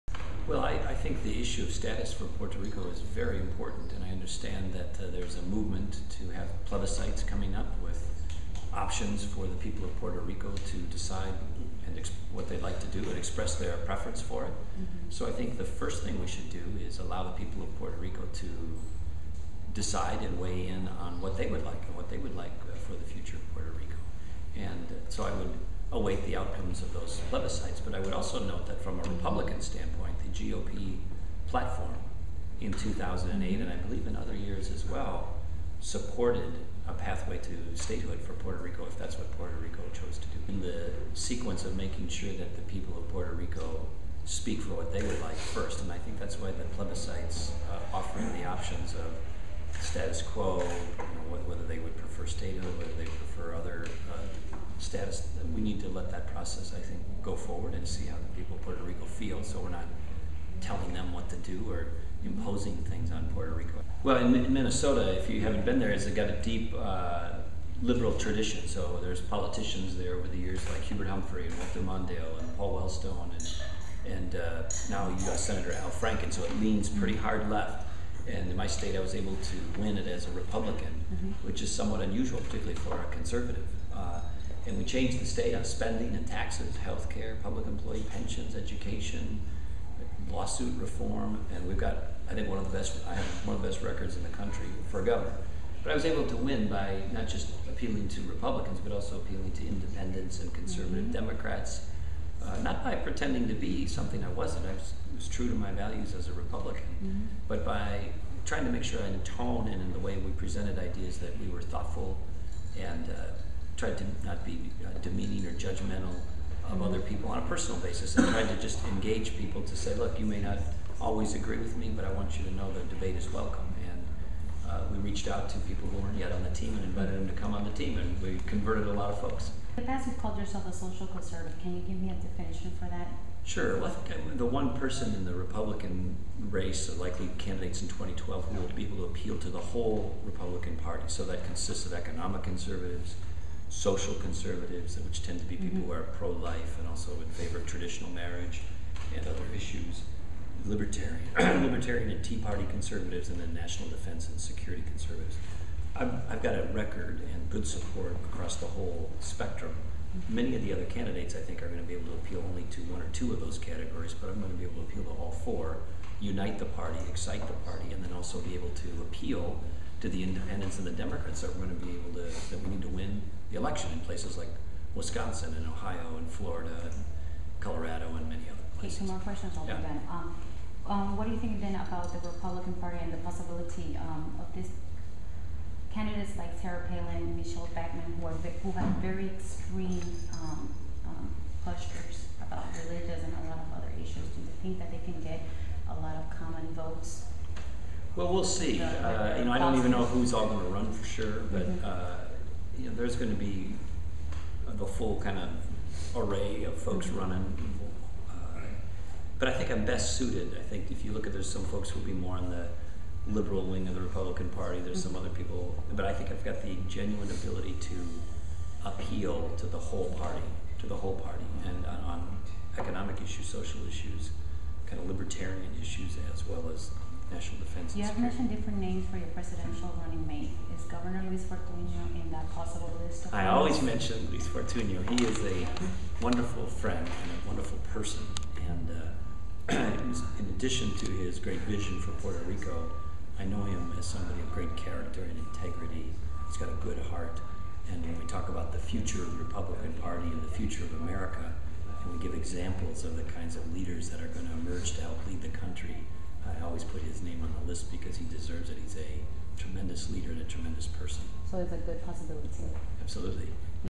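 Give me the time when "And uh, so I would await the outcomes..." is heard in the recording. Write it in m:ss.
0:24.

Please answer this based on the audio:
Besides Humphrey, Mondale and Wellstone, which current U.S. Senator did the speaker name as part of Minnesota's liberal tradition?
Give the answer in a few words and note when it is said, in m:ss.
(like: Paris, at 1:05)
Al Franken, at 1:15.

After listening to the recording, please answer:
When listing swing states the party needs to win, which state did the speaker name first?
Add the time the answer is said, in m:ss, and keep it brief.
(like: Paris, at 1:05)
Wisconsin, at 2:54.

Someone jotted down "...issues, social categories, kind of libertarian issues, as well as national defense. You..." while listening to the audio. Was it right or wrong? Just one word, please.
wrong.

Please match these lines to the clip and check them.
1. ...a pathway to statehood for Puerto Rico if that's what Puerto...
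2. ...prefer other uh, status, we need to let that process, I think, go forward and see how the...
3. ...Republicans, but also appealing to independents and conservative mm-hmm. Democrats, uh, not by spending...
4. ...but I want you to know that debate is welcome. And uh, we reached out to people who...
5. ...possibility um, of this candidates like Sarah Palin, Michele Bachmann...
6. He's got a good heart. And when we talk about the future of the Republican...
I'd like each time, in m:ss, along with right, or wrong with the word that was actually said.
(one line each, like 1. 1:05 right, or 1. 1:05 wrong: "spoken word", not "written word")
1. 0:36 right
2. 0:53 right
3. 1:38 wrong: "pretending", not "spending"
4. 2:01 right
5. 3:03 right
6. 4:06 right.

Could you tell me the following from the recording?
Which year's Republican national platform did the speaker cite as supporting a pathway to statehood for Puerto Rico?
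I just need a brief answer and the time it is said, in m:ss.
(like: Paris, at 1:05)
2008, at 0:32.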